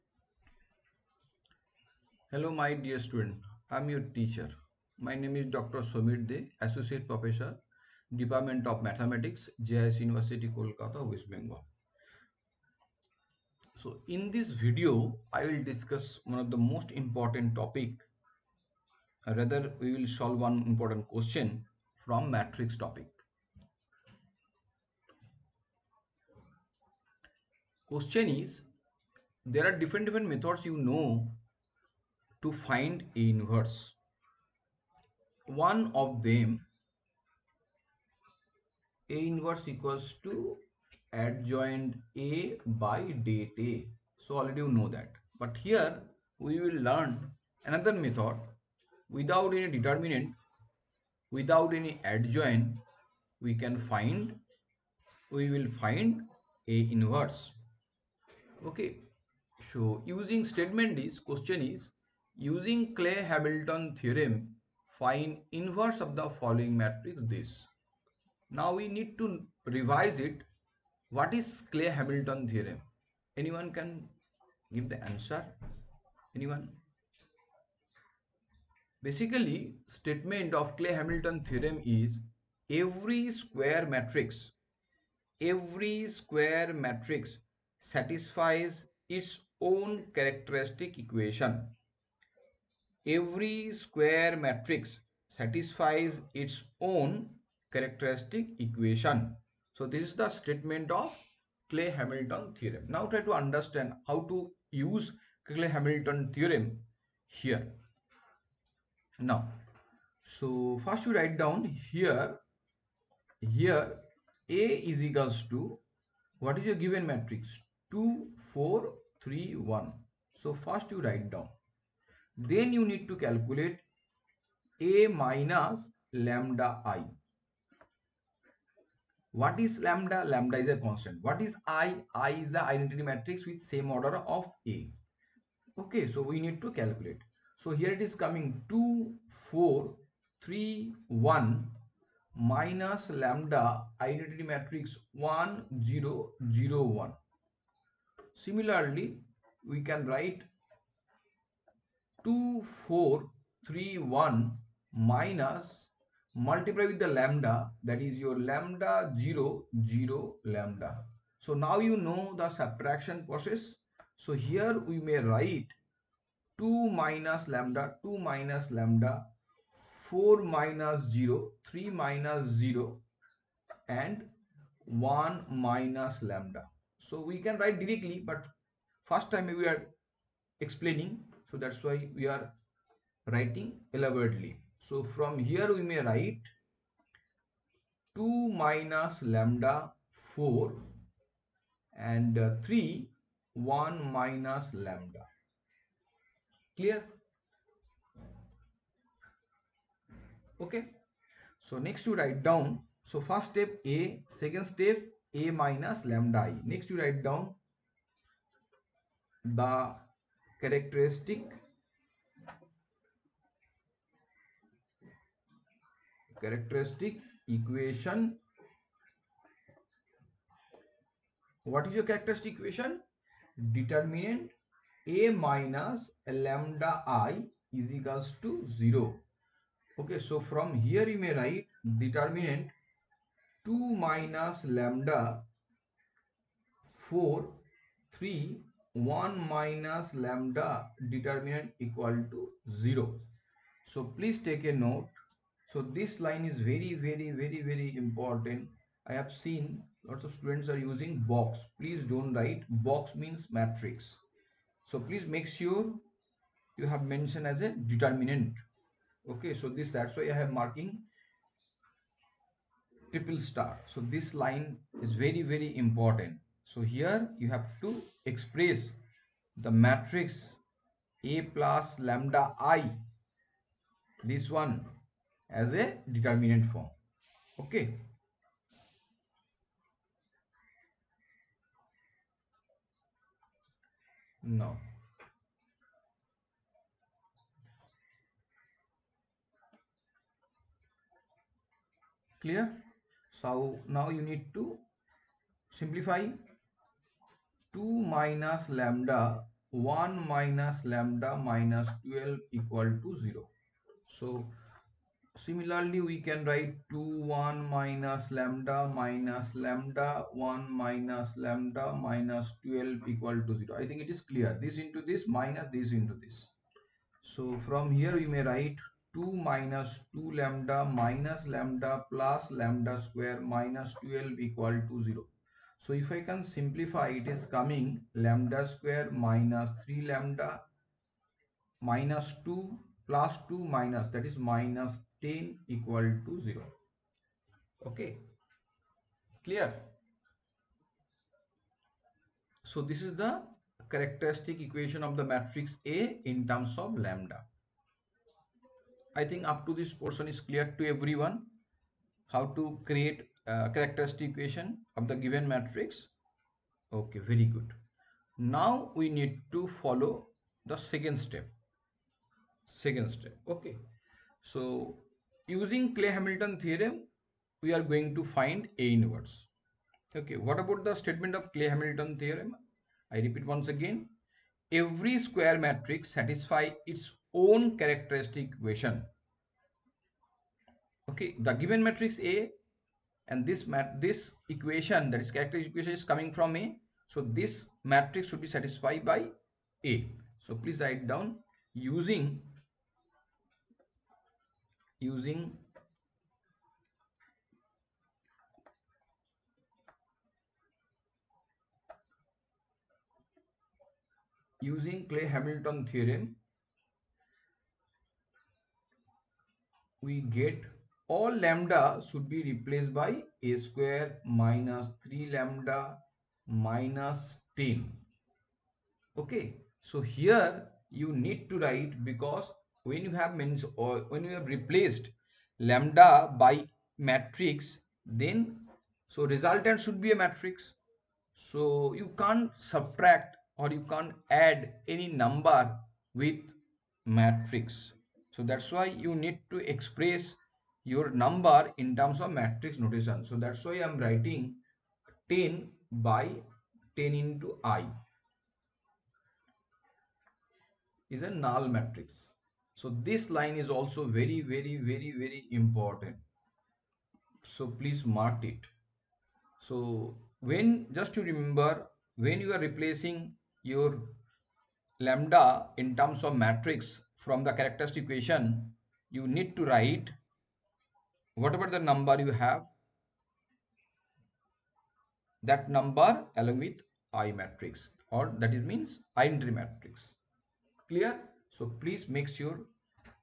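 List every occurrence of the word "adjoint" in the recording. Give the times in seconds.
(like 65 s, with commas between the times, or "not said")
41 s, 52 s.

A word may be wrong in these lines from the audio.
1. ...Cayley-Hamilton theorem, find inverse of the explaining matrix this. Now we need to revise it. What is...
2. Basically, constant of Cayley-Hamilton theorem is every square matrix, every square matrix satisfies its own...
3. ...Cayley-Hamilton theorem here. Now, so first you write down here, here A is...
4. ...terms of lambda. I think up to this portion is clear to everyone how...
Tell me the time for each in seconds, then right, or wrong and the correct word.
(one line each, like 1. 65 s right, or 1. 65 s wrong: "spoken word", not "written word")
1. 62 s wrong: "following", not "explaining"
2. 79 s wrong: "statement", not "constant"
3. 105 s right
4. 346 s right.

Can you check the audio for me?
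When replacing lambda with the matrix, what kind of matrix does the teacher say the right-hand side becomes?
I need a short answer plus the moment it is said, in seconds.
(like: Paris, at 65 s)
null matrix, at 451 s.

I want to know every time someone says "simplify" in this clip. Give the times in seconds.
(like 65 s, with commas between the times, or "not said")
295 s, 326 s.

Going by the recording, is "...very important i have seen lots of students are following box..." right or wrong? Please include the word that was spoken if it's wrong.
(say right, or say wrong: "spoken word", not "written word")
wrong: "using", not "following".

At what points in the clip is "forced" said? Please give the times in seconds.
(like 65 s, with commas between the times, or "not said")
not said.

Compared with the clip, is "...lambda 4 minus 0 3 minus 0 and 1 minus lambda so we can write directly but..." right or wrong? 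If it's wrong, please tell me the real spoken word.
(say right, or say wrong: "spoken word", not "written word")
right.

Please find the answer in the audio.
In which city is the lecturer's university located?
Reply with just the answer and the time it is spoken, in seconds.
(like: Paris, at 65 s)
Kolkata, at 10 s.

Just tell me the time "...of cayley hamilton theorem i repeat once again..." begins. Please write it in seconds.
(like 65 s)
371 s.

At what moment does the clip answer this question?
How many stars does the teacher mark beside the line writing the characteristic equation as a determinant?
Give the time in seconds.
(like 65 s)
263 s.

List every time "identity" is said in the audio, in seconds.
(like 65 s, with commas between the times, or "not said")
132 s, 144 s.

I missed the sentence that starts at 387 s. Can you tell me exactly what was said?
So this matrix should be satisfied by A.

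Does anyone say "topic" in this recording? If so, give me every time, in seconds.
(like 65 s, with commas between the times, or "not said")
17 s, 22 s.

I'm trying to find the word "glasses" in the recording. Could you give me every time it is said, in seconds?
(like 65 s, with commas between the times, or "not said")
not said.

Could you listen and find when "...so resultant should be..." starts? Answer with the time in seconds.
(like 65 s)
429 s.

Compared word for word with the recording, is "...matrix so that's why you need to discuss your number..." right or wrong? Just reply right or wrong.
wrong.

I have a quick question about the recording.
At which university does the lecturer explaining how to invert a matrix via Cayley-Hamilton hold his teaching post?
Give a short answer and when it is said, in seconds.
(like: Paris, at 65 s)
JIS University, at 9 s.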